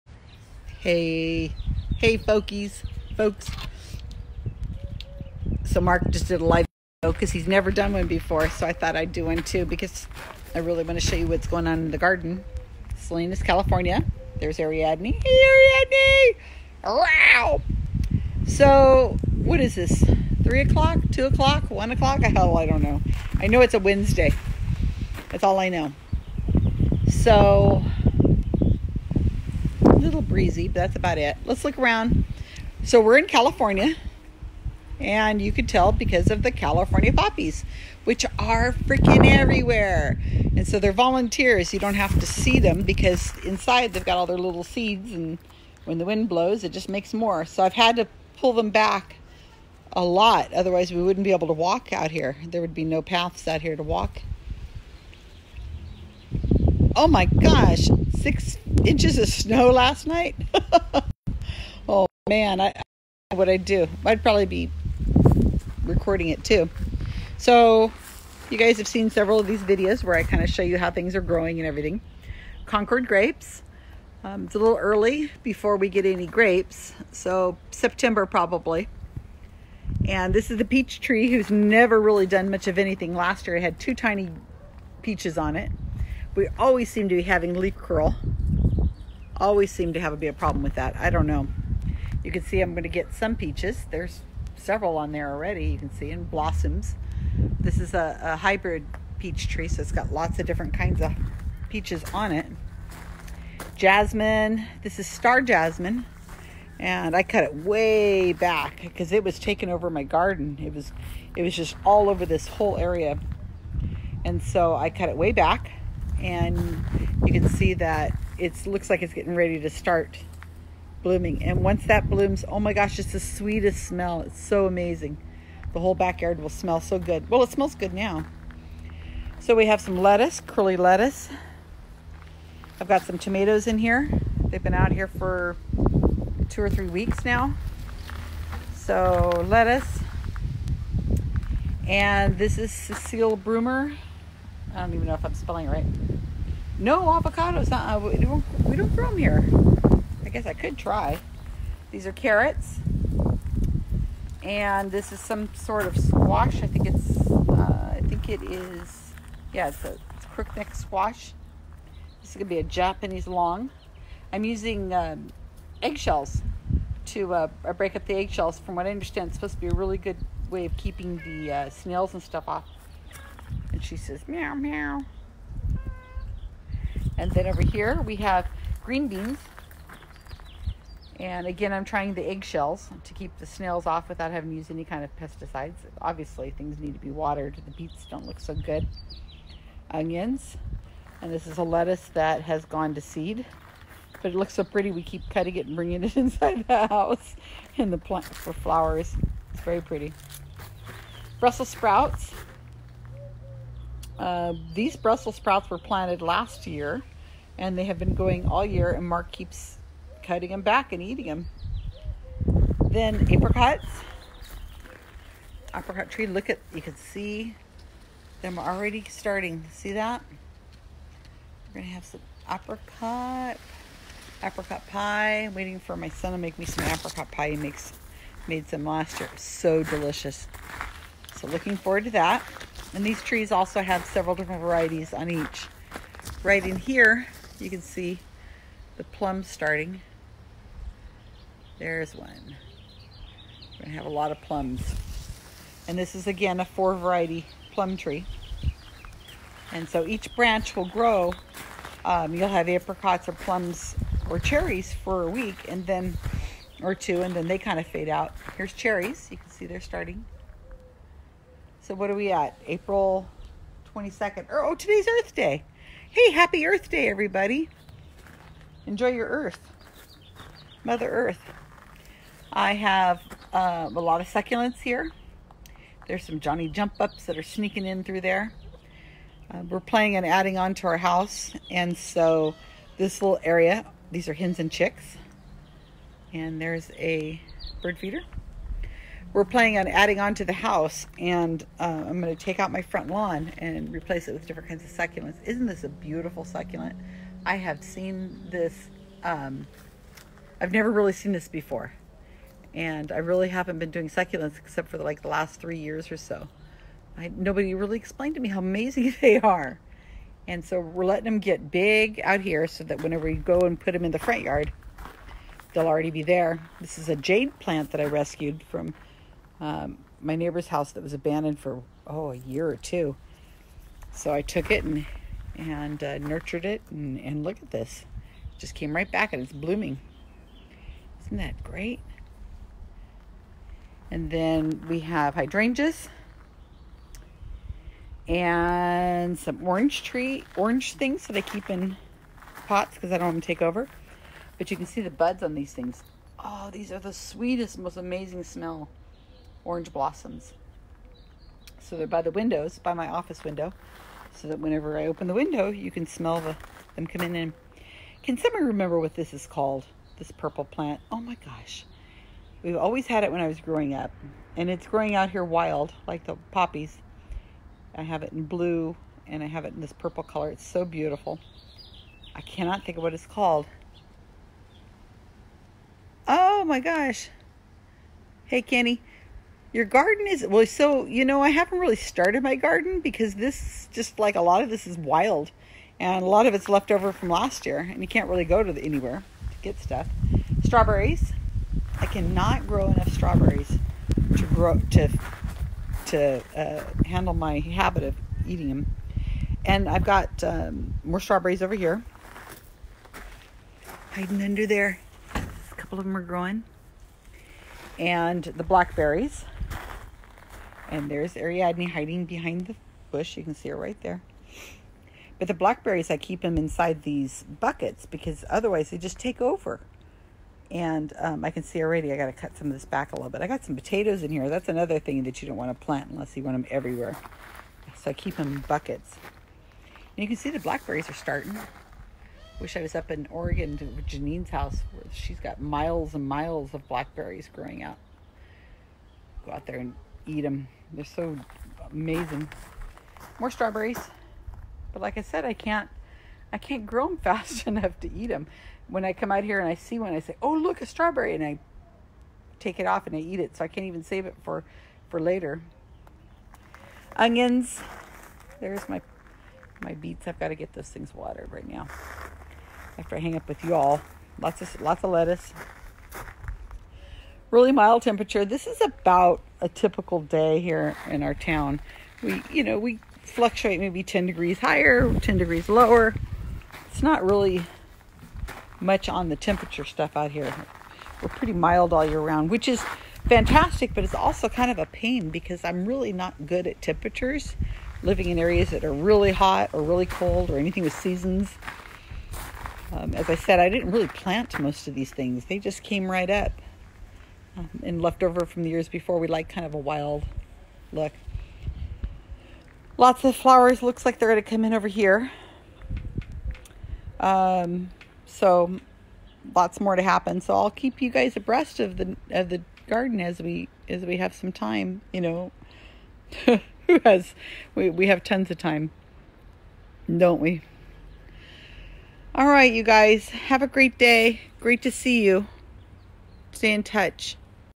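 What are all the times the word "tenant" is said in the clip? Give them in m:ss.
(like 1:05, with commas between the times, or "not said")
not said.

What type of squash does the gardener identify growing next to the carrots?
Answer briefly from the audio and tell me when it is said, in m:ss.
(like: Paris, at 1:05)
Crookneck squash, at 2:40.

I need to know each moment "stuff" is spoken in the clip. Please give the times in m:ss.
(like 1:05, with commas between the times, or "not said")
2:52, 6:29, 7:59.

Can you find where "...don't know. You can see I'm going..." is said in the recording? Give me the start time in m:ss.
1:31.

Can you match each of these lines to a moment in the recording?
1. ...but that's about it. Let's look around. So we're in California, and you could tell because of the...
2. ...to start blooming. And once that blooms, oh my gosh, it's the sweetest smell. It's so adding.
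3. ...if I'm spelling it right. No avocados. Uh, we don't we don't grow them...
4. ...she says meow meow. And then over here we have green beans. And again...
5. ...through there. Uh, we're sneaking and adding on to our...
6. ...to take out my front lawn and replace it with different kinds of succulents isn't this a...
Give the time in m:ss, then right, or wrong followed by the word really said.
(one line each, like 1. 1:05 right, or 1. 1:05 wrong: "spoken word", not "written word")
1. 0:30 right
2. 1:59 wrong: "amazing", not "adding"
3. 2:25 right
4. 2:53 right
5. 4:38 wrong: "playing", not "sneaking"
6. 4:52 right.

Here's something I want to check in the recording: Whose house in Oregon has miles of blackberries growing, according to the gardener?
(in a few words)
Janine's.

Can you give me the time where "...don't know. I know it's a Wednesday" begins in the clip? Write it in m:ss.
0:22.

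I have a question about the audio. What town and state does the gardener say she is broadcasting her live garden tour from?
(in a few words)
Salinas, California.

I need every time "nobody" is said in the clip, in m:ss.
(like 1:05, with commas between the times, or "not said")
5:07.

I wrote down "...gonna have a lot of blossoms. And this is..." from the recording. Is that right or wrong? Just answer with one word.
wrong.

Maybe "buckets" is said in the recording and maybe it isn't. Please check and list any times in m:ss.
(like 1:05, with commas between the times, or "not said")
6:57, 7:08.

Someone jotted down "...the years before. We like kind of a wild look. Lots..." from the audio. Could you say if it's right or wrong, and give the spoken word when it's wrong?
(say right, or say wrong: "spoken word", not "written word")
right.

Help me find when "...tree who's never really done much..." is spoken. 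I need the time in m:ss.
1:21.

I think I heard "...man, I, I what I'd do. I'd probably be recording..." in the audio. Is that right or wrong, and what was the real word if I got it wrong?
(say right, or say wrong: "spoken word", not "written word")
right.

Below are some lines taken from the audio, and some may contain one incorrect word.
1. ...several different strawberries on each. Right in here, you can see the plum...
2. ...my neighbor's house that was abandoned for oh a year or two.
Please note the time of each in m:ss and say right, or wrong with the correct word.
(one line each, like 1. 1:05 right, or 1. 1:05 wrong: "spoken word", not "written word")
1. 3:54 wrong: "varieties", not "strawberries"
2. 5:20 right.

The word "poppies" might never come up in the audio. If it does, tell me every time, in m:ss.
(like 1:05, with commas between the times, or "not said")
0:37, 6:06.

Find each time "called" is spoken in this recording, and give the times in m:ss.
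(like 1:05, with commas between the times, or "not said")
5:59, 6:13.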